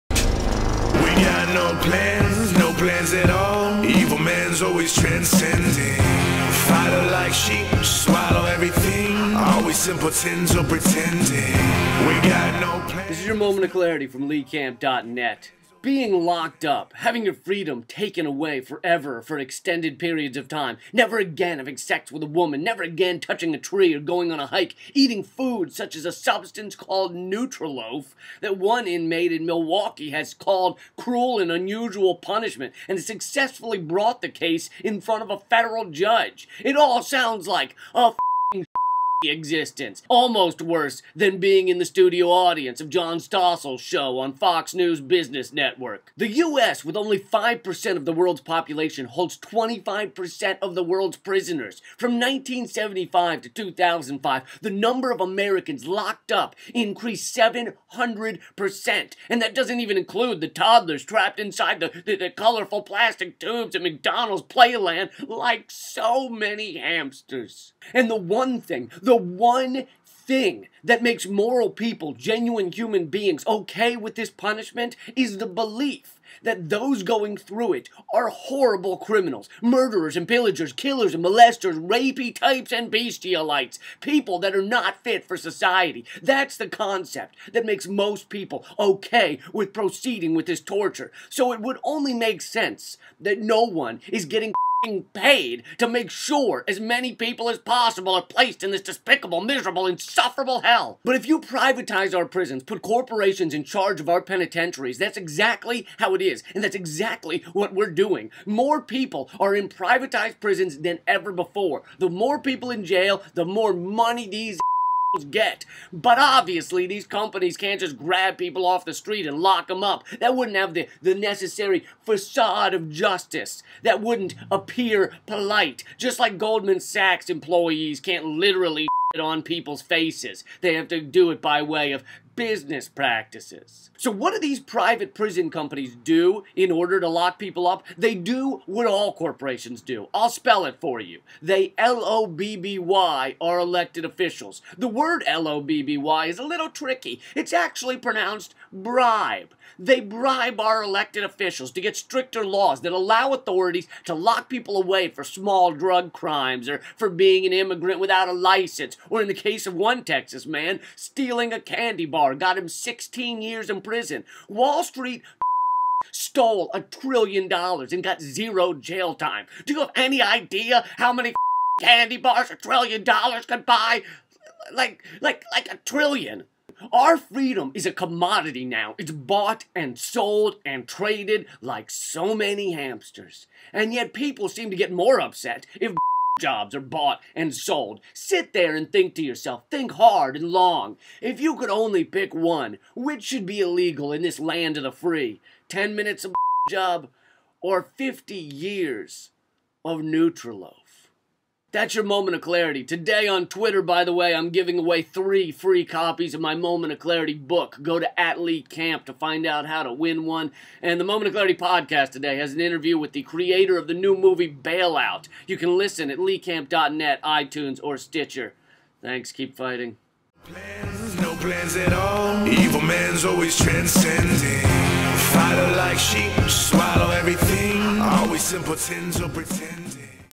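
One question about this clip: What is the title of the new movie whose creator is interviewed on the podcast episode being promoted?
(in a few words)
Bailout.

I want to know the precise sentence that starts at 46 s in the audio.
The US, with only 5% of the world's population, holds 25% of the world's prisoners.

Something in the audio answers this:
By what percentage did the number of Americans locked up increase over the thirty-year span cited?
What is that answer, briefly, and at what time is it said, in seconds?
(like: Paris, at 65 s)
700%, at 57 s.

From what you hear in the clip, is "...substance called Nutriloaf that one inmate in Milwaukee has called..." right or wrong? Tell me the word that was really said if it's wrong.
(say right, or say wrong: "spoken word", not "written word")
right.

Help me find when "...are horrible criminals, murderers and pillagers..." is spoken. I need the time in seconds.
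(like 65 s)
78 s.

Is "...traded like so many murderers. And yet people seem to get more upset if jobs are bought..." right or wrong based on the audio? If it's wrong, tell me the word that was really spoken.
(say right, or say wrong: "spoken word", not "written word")
wrong: "hamsters", not "murderers".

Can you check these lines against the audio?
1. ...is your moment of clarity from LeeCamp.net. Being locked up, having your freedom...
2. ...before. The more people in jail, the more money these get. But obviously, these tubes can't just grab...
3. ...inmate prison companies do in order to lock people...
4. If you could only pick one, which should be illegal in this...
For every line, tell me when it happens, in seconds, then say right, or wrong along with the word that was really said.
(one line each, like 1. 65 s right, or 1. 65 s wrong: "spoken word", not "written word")
1. 13 s right
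2. 111 s wrong: "companies", not "tubes"
3. 134 s wrong: "private", not "inmate"
4. 191 s right.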